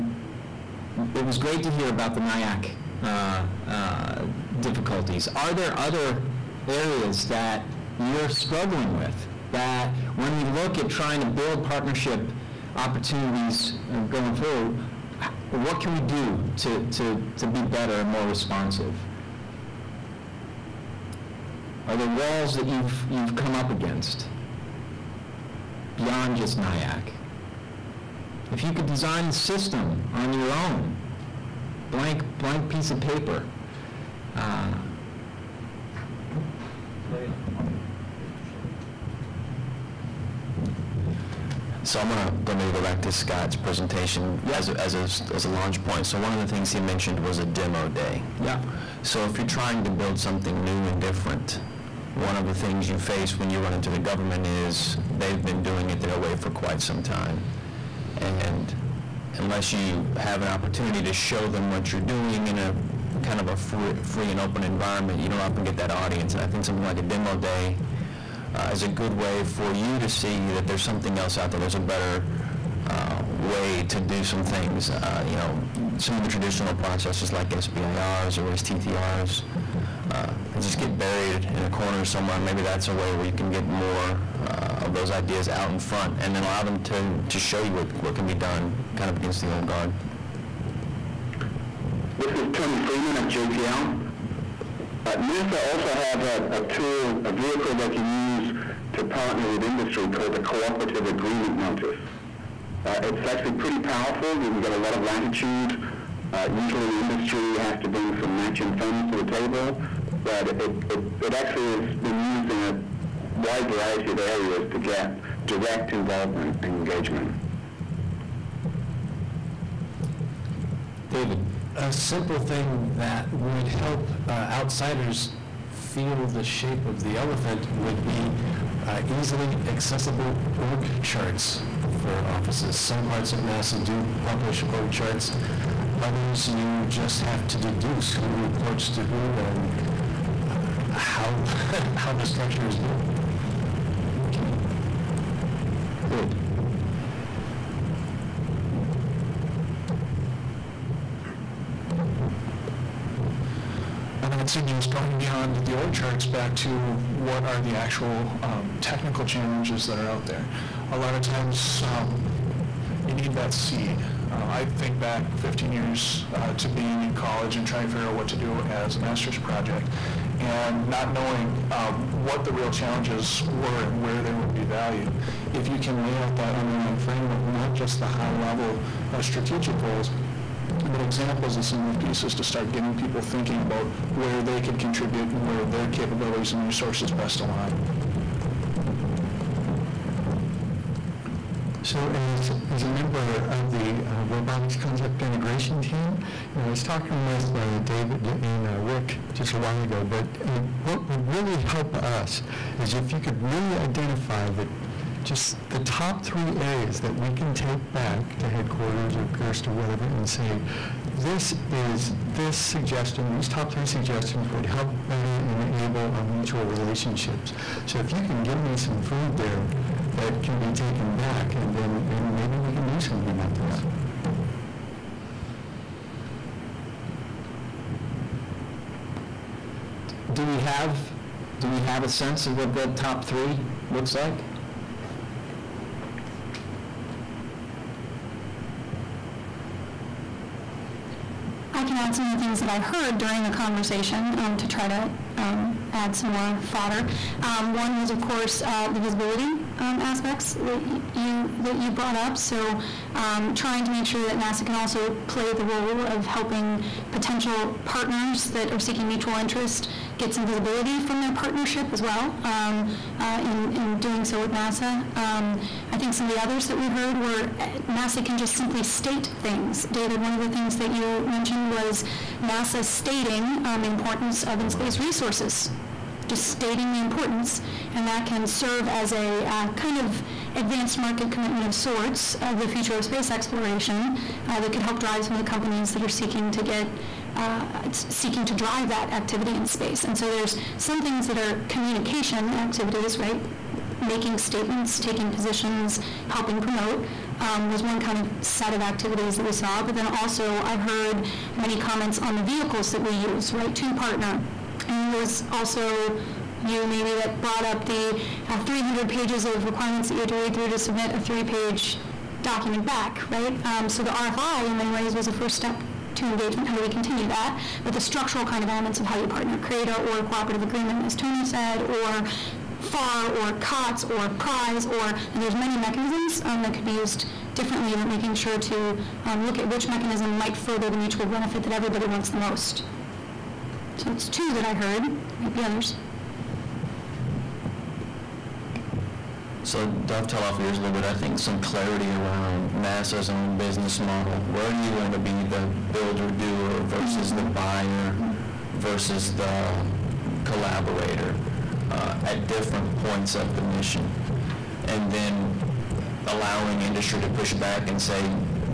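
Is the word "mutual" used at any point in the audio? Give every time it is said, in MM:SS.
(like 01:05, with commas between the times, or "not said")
03:36, 04:19, 05:30.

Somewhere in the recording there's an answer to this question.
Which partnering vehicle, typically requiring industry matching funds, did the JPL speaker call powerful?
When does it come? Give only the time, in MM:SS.
01:40.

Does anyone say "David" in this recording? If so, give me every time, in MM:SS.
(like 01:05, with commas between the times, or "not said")
02:01, 03:17, 04:29.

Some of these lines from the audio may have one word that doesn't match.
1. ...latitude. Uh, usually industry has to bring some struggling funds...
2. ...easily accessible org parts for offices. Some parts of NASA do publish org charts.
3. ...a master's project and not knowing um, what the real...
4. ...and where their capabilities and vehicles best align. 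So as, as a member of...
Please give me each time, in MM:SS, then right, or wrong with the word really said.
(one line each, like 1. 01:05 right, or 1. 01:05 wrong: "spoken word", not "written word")
1. 01:45 wrong: "matching", not "struggling"
2. 02:09 wrong: "charts", not "parts"
3. 02:48 right
4. 03:05 wrong: "resources", not "vehicles".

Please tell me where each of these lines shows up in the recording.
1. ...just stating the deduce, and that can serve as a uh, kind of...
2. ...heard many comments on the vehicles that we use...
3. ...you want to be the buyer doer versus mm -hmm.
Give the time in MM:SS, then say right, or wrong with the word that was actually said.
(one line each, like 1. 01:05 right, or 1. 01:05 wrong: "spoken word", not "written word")
1. 04:36 wrong: "importance", not "deduce"
2. 05:00 right
3. 05:44 wrong: "builder", not "buyer".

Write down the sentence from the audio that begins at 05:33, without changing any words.
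So it's two that I heard, might be others.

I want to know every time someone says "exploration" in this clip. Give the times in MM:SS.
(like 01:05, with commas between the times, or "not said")
04:43.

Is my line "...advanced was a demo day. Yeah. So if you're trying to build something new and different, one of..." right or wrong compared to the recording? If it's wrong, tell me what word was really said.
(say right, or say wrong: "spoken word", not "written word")
wrong: "mentioned", not "advanced".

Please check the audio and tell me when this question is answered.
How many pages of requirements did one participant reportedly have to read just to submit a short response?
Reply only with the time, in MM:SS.
05:08.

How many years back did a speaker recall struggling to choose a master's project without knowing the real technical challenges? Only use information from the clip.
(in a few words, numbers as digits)
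15.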